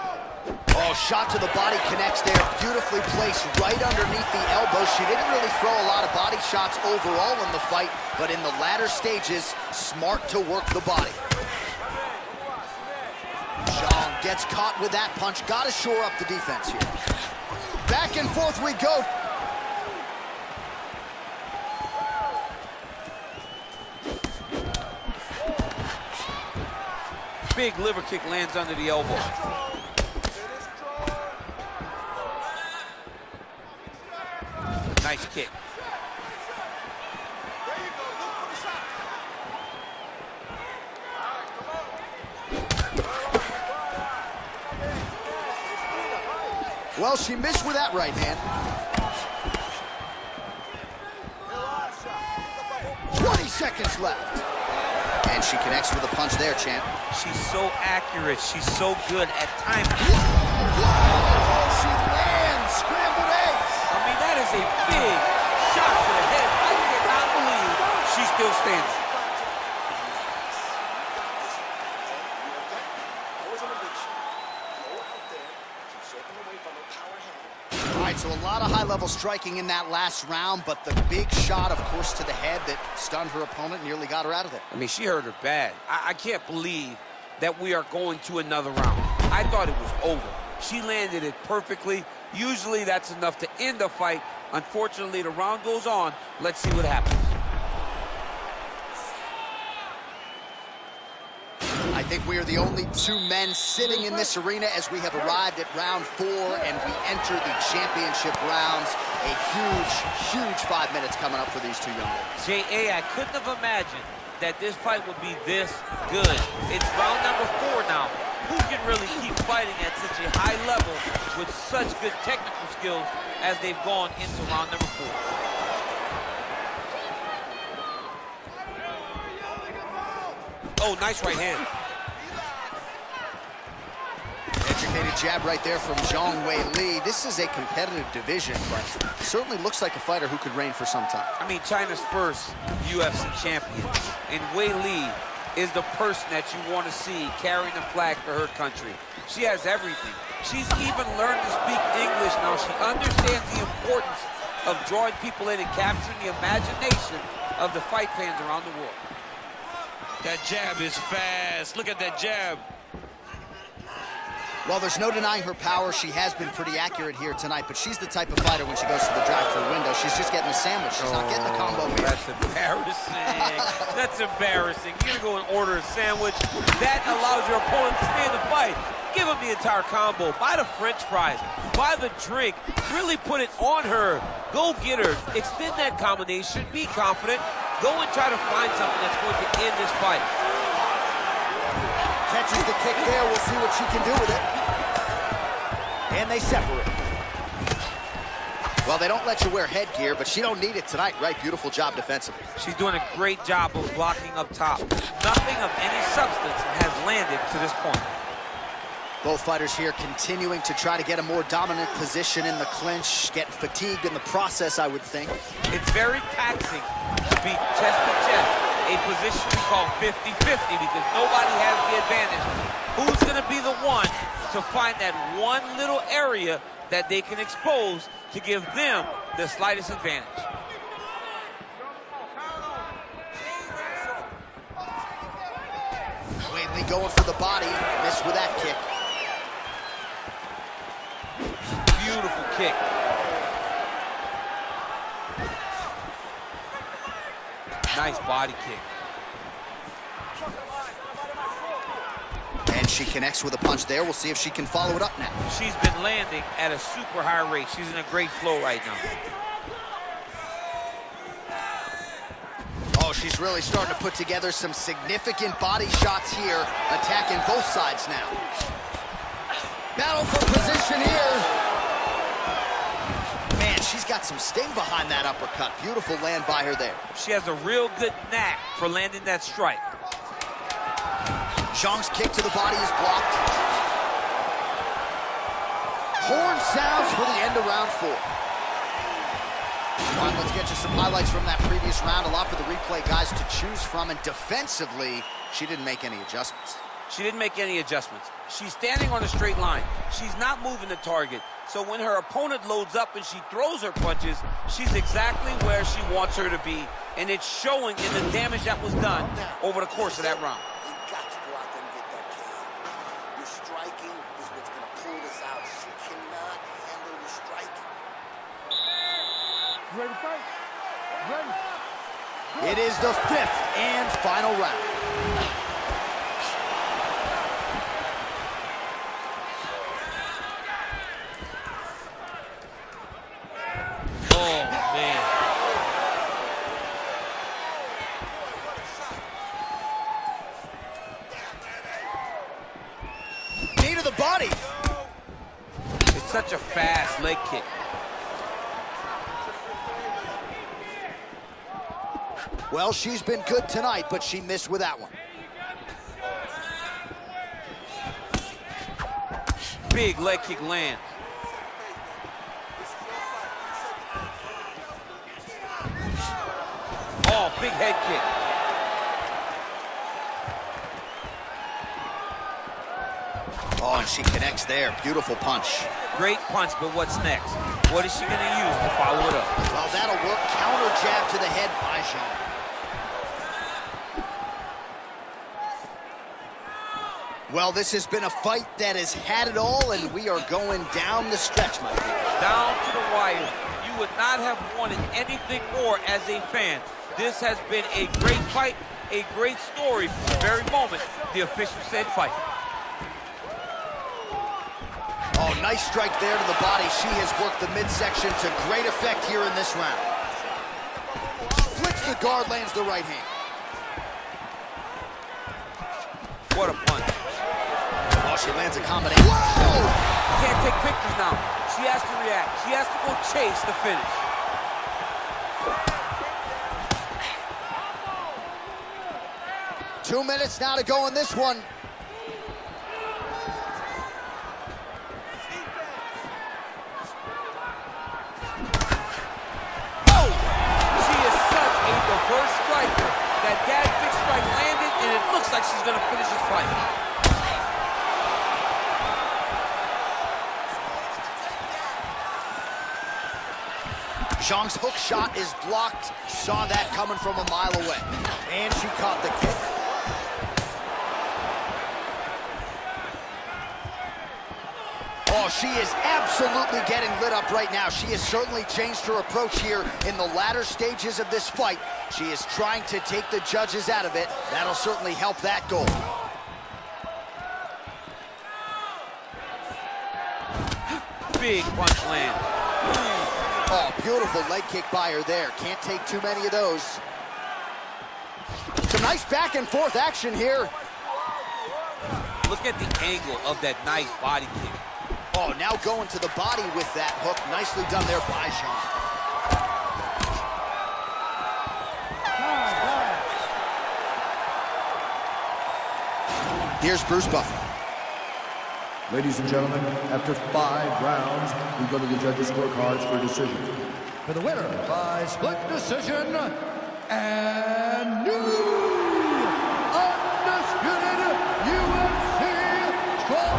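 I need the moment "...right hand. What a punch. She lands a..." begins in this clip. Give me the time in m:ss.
6:52.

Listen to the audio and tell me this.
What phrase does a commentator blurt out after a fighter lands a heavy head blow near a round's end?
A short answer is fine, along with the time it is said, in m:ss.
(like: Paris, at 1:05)
Scrambled egg, at 1:02.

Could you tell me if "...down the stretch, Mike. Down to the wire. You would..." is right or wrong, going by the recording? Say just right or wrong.
right.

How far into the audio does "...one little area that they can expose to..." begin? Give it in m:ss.
3:45.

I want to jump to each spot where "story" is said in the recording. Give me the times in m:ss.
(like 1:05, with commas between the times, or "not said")
6:39.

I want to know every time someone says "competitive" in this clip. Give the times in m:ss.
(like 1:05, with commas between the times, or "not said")
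2:17.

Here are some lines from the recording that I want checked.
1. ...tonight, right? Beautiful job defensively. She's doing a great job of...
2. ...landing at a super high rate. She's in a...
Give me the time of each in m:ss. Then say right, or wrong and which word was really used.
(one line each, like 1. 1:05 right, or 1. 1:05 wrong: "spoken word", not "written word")
1. 3:20 right
2. 4:16 right.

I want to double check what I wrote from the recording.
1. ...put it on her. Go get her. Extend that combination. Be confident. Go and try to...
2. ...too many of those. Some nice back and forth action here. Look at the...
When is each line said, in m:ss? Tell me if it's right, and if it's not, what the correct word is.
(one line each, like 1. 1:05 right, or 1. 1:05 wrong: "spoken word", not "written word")
1. 3:03 right
2. 8:06 right.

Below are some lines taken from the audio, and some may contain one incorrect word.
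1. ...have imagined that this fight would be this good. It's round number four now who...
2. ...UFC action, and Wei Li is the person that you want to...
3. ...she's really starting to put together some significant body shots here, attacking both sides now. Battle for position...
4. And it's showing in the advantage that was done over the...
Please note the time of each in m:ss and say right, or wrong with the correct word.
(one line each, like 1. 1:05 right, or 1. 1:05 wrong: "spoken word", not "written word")
1. 1:53 right
2. 2:22 wrong: "champion", not "action"
3. 4:23 right
4. 5:07 wrong: "damage", not "advantage".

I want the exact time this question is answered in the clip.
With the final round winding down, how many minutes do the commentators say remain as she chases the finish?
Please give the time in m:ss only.
7:10.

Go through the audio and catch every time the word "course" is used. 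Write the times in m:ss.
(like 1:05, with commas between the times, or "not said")
1:21, 5:09.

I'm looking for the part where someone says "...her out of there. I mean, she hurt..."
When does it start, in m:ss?
1:24.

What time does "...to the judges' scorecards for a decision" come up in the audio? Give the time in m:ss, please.
8:32.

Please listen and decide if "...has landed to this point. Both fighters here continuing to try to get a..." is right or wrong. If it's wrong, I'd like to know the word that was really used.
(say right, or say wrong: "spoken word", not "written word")
right.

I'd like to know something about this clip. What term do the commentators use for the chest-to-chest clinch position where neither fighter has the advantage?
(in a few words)
50-50.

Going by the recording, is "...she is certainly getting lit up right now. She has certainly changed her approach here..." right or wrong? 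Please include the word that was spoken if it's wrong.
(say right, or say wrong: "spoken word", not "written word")
wrong: "absolutely", not "certainly".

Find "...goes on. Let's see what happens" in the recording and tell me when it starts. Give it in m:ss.
1:35.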